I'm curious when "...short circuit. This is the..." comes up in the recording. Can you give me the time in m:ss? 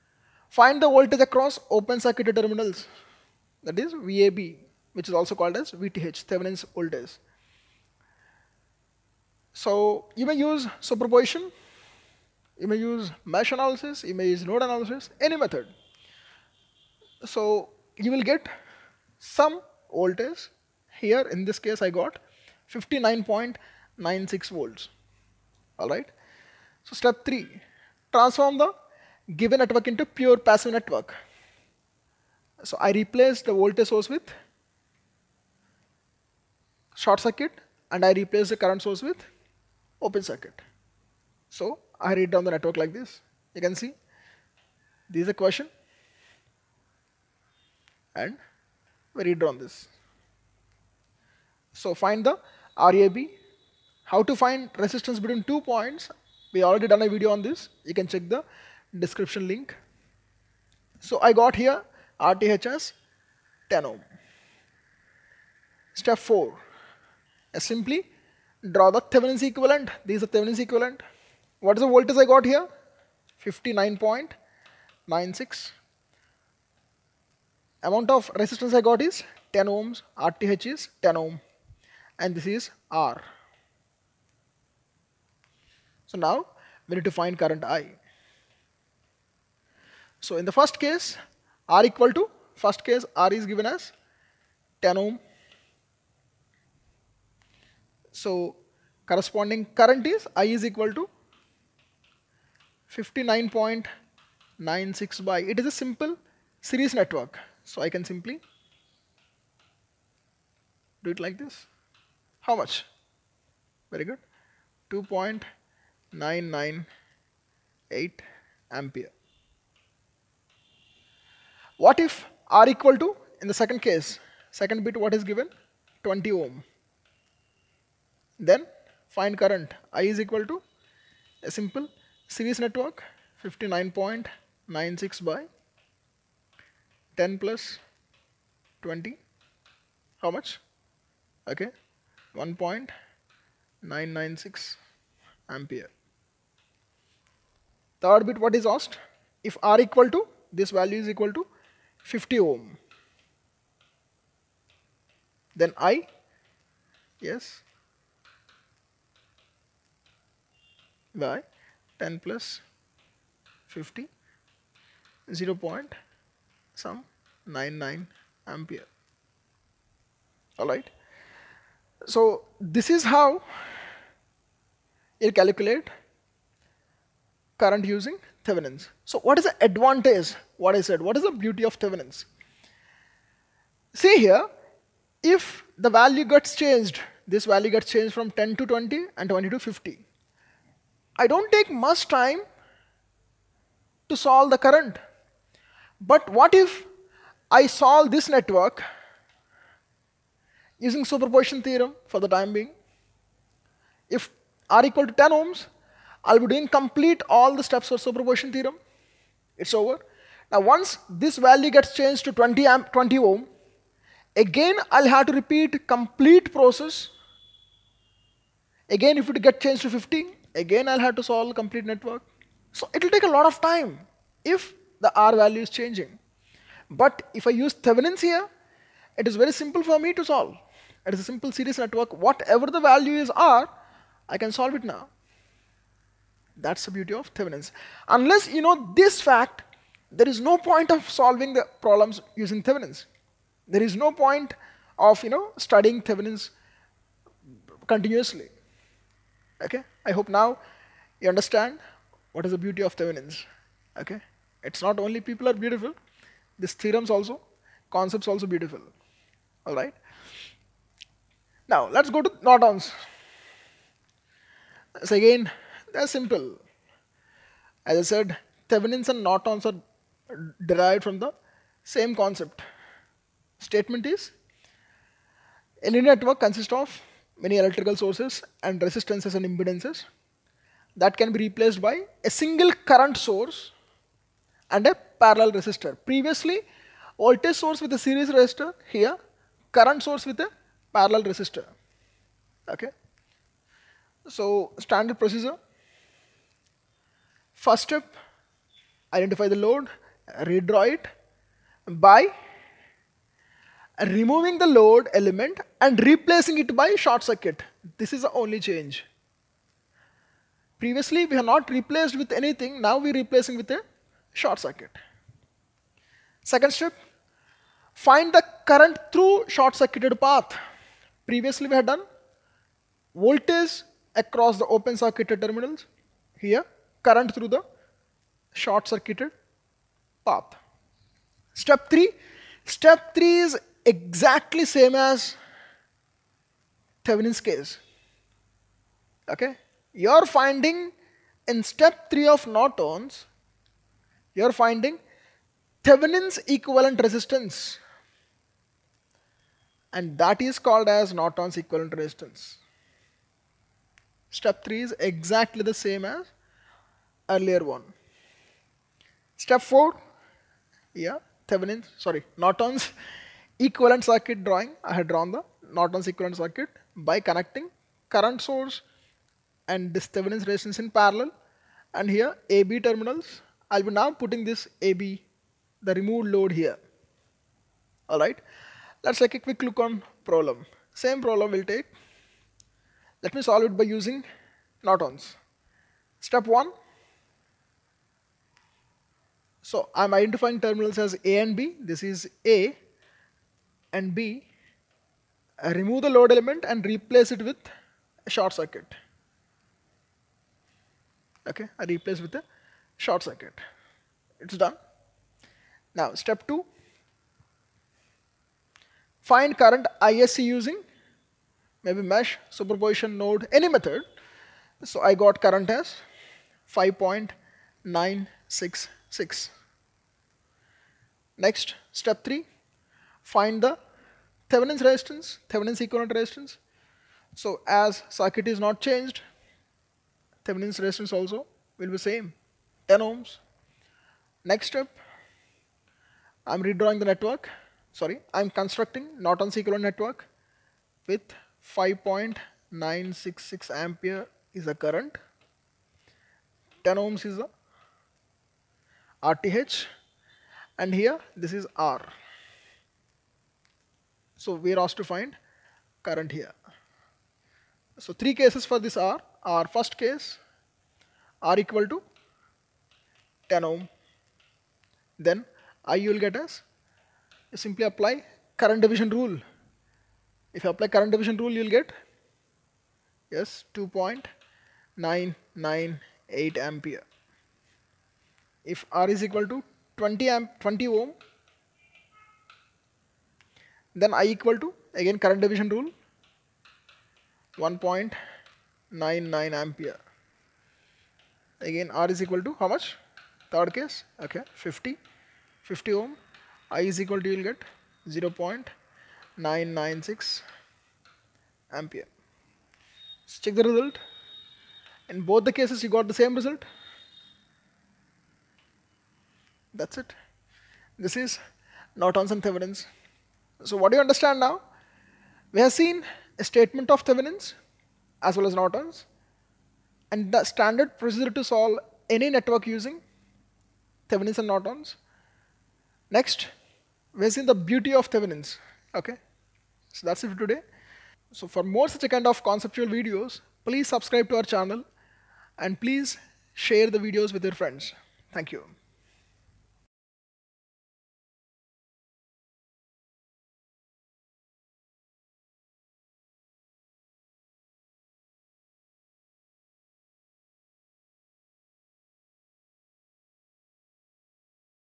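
5:06.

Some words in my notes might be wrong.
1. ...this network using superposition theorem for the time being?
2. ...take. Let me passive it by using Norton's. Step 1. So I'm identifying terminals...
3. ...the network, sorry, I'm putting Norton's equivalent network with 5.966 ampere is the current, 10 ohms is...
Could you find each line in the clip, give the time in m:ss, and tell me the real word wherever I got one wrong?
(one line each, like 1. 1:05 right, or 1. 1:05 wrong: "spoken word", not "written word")
1. 3:18 right
2. 6:21 wrong: "solve", not "passive"
3. 7:16 wrong: "constructing", not "putting".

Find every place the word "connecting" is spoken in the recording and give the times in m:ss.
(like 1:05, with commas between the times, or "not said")
6:07.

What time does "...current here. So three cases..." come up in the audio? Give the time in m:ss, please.
7:36.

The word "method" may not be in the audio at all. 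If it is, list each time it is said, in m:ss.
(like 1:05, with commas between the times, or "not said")
0:15, 6:53.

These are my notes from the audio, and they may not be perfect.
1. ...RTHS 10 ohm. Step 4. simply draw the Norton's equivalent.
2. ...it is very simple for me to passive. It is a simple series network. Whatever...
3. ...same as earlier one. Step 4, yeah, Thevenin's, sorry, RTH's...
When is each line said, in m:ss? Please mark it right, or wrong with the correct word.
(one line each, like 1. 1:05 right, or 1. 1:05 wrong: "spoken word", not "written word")
1. 1:02 wrong: "Thevenin", not "Norton"
2. 3:49 wrong: "solve", not "passive"
3. 5:55 wrong: "Norton", not "RTH".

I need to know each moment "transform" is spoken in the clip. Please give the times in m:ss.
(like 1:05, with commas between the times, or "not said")
0:28.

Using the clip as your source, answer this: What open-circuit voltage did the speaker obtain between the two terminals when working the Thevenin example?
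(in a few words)
59.96 volts.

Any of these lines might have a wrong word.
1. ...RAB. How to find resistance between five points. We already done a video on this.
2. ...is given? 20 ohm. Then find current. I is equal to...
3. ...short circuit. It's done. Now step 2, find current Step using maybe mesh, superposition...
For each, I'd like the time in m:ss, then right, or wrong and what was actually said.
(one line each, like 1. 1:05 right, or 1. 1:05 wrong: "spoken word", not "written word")
1. 0:52 wrong: "two", not "five"
2. 2:05 right
3. 6:42 wrong: "ISC", not "Step".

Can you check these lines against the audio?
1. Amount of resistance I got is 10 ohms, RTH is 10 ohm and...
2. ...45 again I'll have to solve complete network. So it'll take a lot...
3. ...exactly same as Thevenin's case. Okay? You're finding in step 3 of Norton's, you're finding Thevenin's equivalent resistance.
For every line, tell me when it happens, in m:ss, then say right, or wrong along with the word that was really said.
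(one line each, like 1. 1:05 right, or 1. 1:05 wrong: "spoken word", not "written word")
1. 1:17 right
2. 3:39 wrong: "15", not "45"
3. 5:33 right.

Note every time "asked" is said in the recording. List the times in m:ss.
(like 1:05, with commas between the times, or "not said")
2:28, 7:34.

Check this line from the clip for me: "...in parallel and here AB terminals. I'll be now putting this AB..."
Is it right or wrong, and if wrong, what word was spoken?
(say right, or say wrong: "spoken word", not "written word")
right.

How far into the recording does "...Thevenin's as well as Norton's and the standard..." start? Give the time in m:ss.
8:37.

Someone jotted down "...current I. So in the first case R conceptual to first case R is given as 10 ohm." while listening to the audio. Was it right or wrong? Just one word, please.
wrong.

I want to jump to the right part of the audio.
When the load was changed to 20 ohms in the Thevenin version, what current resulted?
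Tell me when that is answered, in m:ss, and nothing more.
2:22.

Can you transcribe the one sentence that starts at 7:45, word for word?
Then I you will get as simply apply current division rule.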